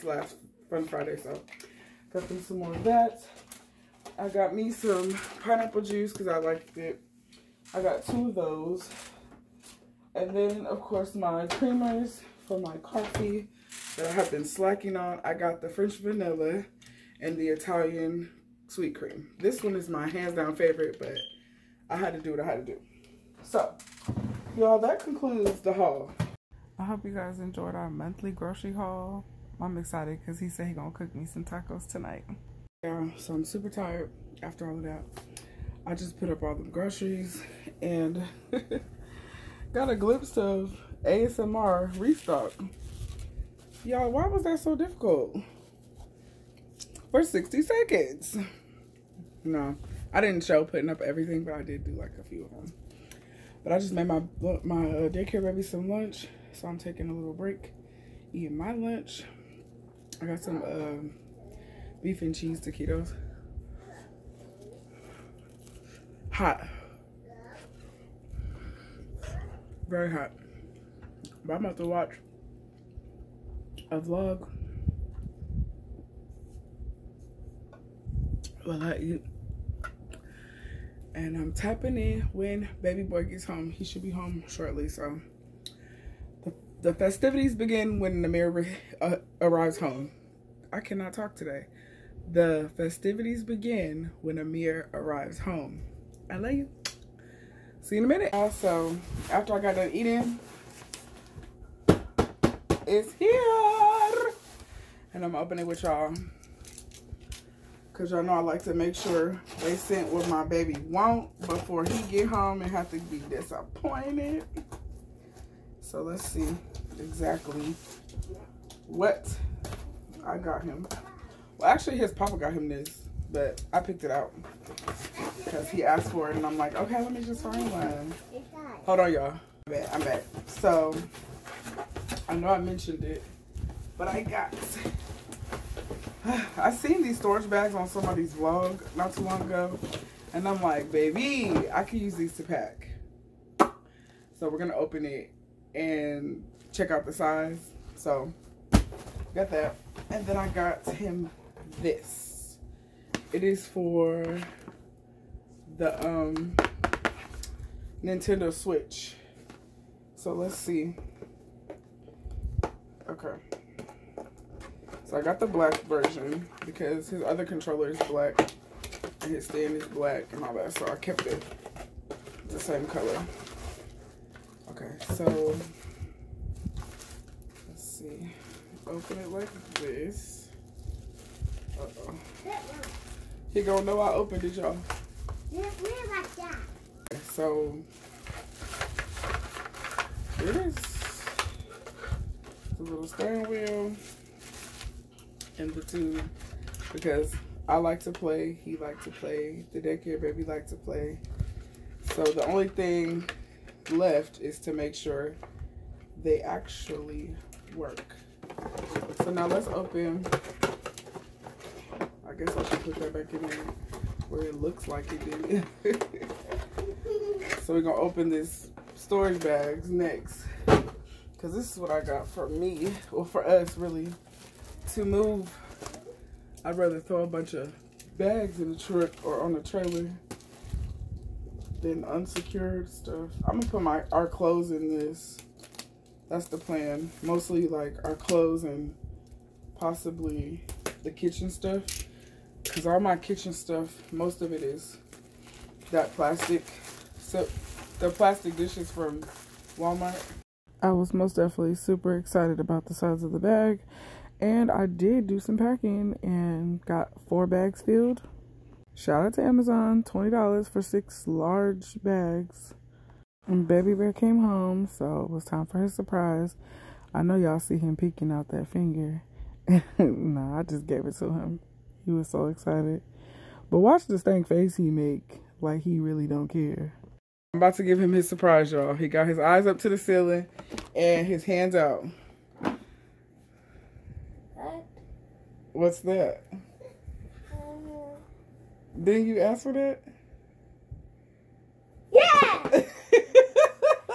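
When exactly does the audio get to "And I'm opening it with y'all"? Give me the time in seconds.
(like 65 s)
105 s.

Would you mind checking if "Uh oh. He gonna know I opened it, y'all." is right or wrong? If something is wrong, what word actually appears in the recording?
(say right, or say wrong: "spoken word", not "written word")
right.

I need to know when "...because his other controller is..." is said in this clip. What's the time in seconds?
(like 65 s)
166 s.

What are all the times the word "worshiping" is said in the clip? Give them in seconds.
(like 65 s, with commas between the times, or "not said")
not said.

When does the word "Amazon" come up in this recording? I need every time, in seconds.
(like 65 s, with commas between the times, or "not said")
259 s.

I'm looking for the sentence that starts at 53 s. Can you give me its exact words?
But I just made my my uh, daycare baby some lunch, so I'm taking a little break, eating my lunch.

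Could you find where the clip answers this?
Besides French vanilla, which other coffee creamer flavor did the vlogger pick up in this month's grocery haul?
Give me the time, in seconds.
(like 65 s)
17 s.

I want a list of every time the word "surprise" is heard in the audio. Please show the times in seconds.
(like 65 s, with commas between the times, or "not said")
265 s, 278 s.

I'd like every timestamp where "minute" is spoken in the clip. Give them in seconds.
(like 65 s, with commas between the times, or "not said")
98 s.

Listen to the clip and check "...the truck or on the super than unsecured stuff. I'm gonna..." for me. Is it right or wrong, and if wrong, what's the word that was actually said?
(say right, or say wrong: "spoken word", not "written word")
wrong: "trailer", not "super".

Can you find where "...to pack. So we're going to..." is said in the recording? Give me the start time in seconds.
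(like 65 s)
142 s.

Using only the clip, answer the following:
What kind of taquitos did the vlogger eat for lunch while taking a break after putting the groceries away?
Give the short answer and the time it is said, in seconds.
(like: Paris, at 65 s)
beef and cheese, at 62 s.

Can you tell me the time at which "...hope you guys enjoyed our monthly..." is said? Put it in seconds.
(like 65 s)
26 s.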